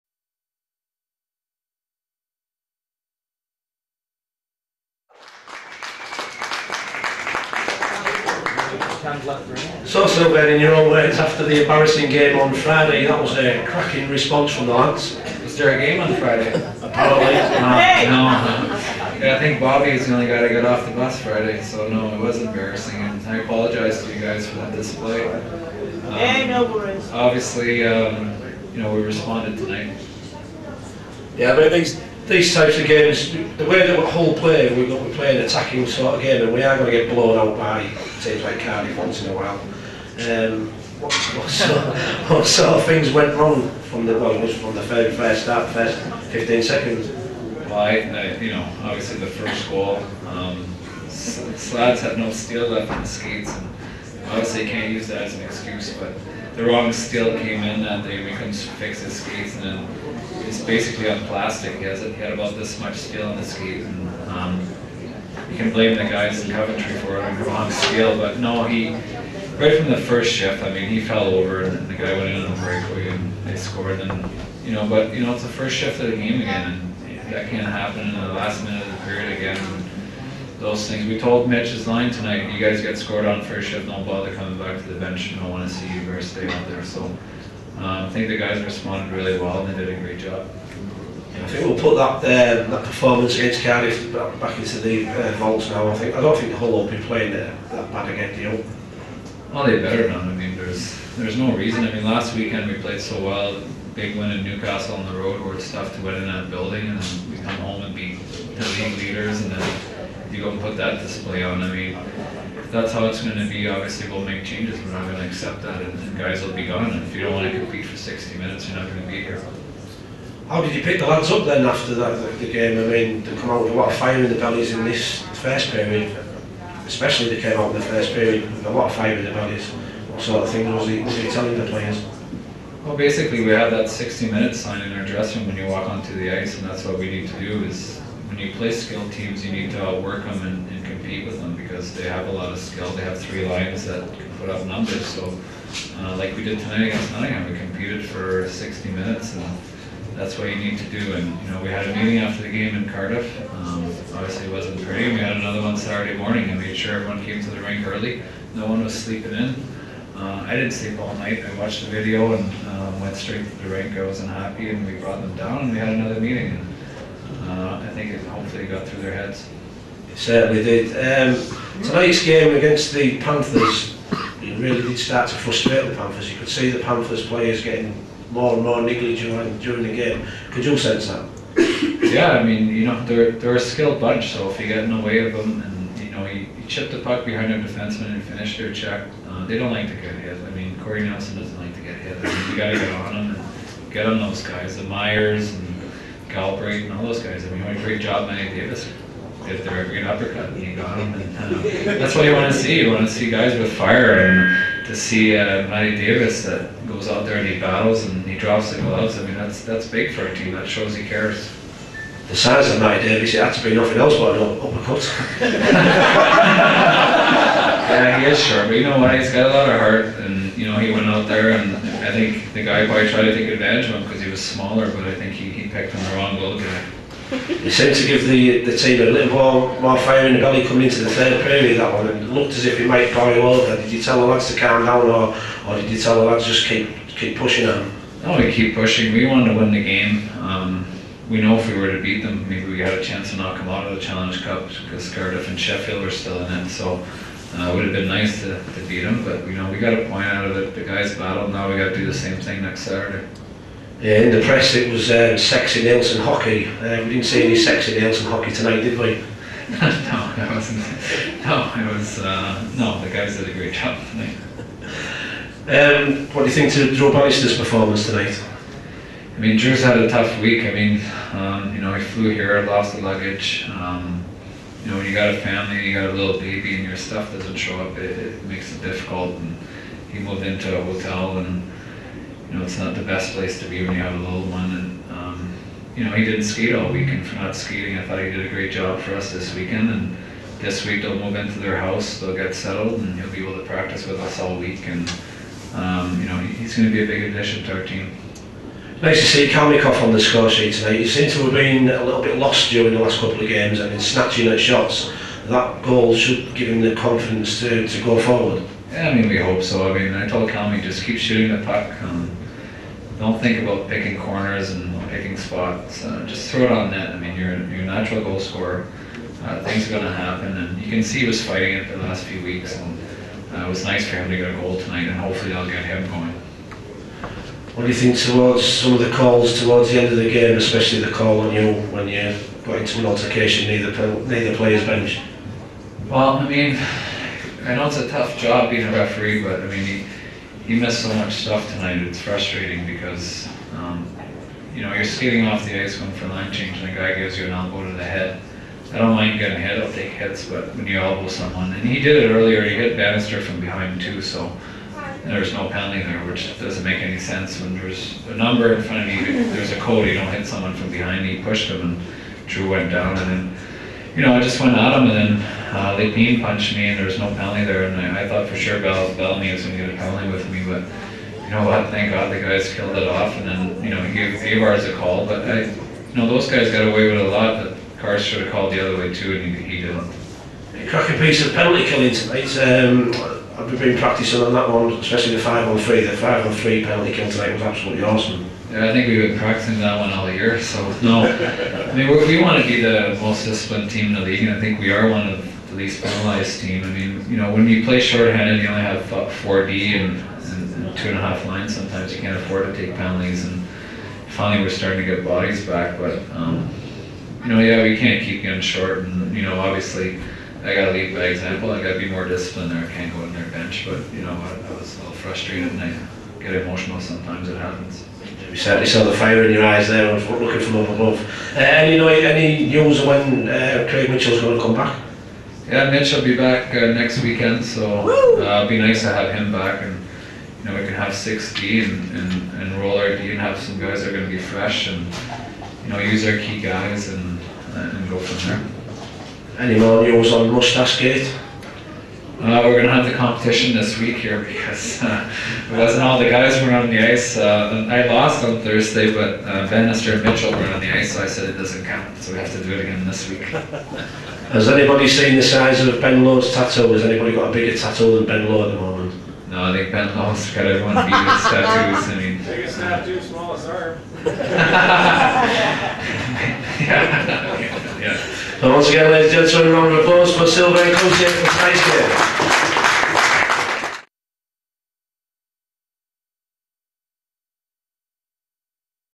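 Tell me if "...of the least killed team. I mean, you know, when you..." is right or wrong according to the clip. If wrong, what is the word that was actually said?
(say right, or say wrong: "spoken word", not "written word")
wrong: "penalized", not "killed".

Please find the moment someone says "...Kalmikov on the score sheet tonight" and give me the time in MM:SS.
04:59.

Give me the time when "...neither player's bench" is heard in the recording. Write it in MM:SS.
05:34.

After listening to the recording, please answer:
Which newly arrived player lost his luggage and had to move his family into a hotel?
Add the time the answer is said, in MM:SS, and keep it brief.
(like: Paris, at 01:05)
Drew Bannister, at 04:26.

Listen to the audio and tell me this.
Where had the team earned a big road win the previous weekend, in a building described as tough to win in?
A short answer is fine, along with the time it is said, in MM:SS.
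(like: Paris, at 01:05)
Newcastle, at 01:44.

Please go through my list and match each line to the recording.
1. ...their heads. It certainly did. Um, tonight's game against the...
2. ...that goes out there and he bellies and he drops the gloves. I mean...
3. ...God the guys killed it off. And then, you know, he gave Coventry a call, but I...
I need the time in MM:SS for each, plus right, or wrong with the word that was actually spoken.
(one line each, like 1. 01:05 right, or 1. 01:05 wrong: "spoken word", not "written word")
1. 02:49 right
2. 03:26 wrong: "battles", not "bellies"
3. 06:12 wrong: "Avars", not "Coventry".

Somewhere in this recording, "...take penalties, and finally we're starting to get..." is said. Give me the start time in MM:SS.
06:42.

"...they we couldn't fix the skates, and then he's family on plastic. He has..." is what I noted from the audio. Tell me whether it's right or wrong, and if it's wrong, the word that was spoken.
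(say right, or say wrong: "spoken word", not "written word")
wrong: "basically", not "family".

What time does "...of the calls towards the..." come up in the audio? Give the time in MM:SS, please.
05:28.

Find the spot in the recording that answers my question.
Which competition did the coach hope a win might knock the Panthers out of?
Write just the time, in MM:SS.
04:04.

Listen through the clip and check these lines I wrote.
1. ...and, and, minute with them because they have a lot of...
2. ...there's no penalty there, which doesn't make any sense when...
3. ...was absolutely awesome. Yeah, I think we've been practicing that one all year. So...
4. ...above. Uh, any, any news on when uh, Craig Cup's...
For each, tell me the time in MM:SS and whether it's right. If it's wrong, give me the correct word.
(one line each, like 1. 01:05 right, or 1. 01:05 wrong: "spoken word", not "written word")
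1. 02:20 wrong: "compete", not "minute"
2. 05:55 right
3. 06:27 right
4. 07:00 wrong: "Mitchell", not "Cup".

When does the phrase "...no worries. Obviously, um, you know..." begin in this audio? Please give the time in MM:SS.
00:26.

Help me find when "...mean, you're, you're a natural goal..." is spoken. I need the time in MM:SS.
05:17.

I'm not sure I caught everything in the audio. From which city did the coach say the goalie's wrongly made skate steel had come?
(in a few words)
Coventry.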